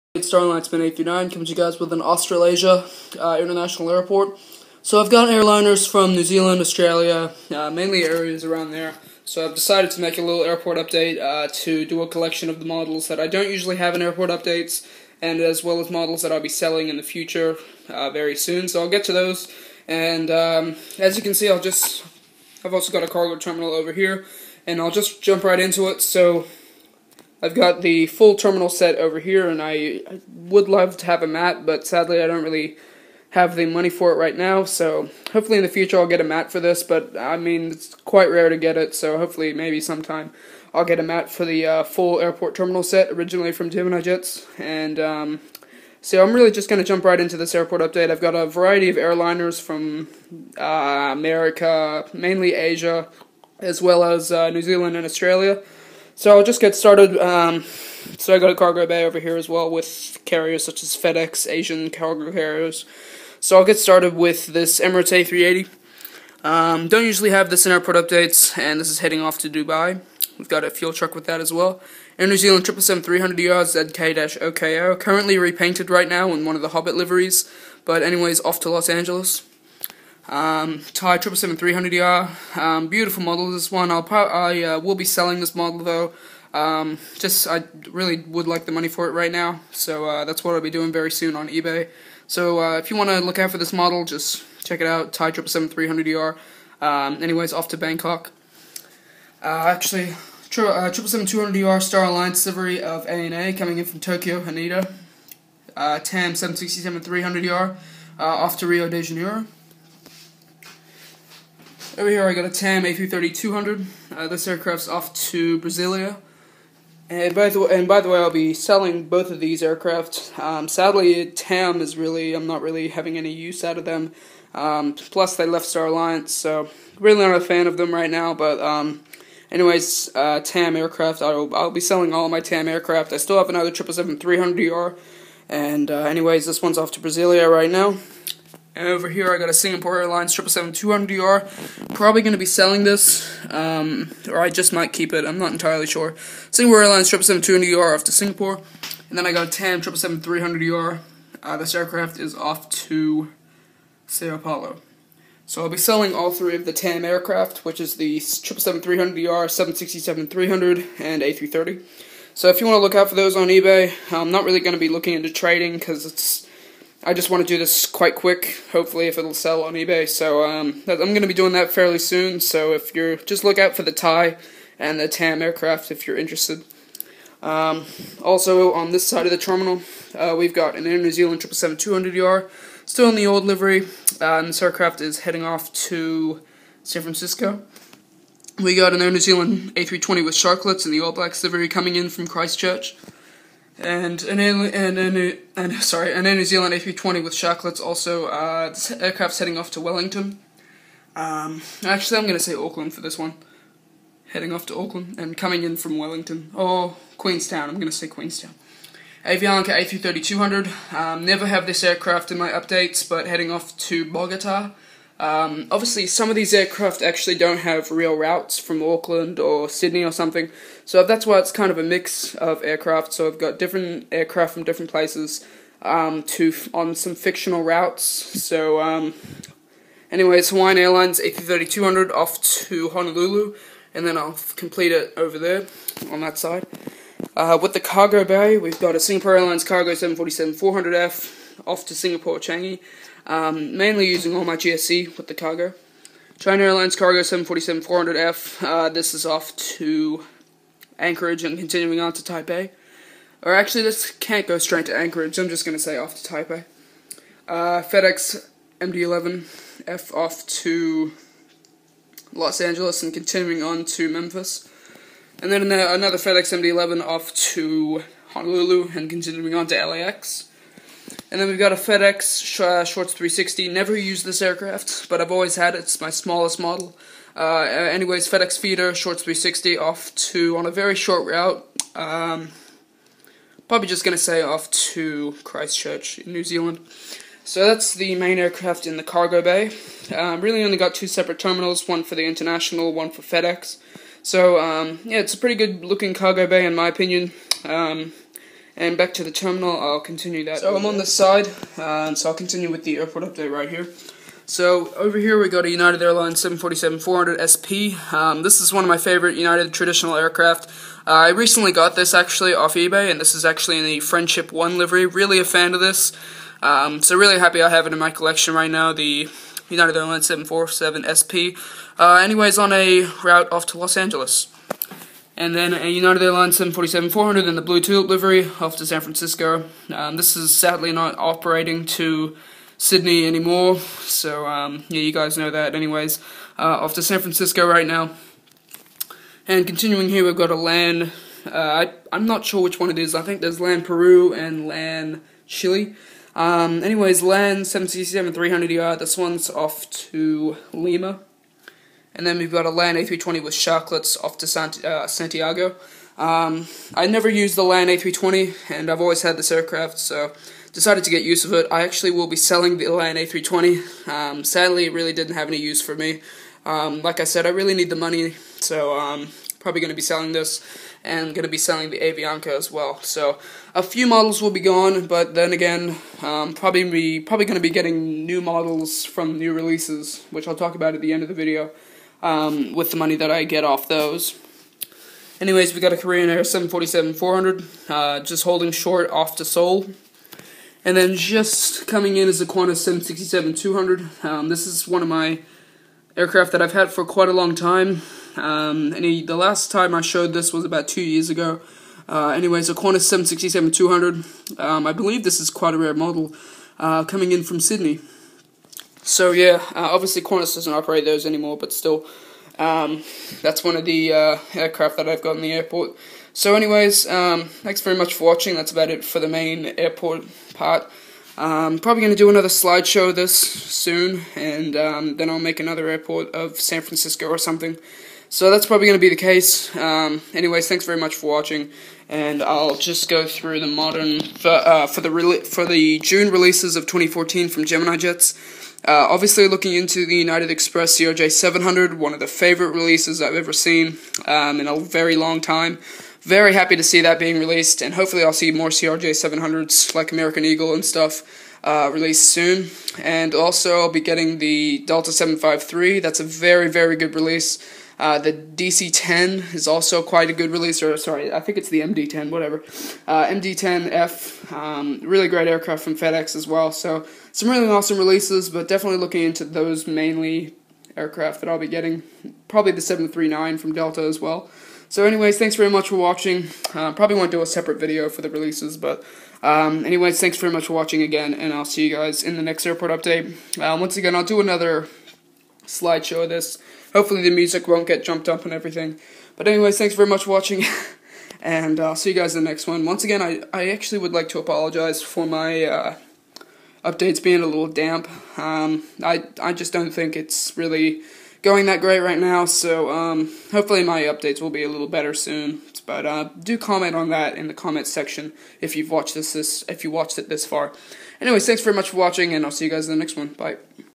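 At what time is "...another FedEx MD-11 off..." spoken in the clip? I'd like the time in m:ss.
4:25.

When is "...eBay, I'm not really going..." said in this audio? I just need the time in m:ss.
2:43.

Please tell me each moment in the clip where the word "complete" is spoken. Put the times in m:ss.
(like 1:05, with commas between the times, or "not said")
3:54.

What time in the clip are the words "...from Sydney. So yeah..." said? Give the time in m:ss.
6:47.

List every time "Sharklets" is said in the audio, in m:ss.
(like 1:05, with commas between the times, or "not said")
3:10, 3:17, 5:53.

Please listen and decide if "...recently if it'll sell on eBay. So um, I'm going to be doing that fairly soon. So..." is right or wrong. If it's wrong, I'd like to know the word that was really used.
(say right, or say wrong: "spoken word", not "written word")
wrong: "hopefully", not "recently".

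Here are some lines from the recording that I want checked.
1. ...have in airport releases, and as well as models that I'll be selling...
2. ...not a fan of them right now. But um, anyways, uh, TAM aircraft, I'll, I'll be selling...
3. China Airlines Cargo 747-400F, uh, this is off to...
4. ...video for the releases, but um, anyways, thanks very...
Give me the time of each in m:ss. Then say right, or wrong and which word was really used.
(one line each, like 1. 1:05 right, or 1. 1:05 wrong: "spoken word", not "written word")
1. 0:13 wrong: "updates", not "releases"
2. 2:07 right
3. 4:06 right
4. 7:57 right.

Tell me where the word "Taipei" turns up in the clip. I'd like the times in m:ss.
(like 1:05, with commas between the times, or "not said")
4:12, 4:16.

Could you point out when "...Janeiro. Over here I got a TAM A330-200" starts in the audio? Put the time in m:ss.
1:49.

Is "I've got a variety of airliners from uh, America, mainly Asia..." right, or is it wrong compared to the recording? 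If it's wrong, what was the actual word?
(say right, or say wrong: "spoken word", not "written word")
right.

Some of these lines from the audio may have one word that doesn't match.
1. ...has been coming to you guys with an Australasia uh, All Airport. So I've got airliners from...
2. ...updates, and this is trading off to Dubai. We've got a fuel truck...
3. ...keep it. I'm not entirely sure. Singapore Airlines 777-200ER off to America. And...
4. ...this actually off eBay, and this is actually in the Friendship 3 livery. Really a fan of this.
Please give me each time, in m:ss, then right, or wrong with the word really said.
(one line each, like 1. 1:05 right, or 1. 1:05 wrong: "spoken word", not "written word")
1. 0:00 wrong: "International", not "All"
2. 1:07 wrong: "heading", not "trading"
3. 2:24 wrong: "Singapore", not "America"
4. 5:11 wrong: "1", not "3".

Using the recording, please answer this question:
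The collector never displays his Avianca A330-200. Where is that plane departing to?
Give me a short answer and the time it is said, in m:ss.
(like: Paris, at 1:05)
Bogota, at 3:34.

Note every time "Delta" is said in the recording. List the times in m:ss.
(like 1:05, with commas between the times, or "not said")
7:34, 7:53.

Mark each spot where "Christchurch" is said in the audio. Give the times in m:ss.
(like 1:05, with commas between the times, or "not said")
3:12, 4:45.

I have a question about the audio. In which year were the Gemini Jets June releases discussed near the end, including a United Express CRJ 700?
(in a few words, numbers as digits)
2014.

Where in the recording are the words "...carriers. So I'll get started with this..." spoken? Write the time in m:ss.
1:02.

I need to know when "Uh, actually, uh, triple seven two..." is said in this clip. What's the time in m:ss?
1:39.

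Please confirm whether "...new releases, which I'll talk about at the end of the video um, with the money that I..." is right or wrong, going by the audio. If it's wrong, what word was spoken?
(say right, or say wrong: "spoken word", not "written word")
right.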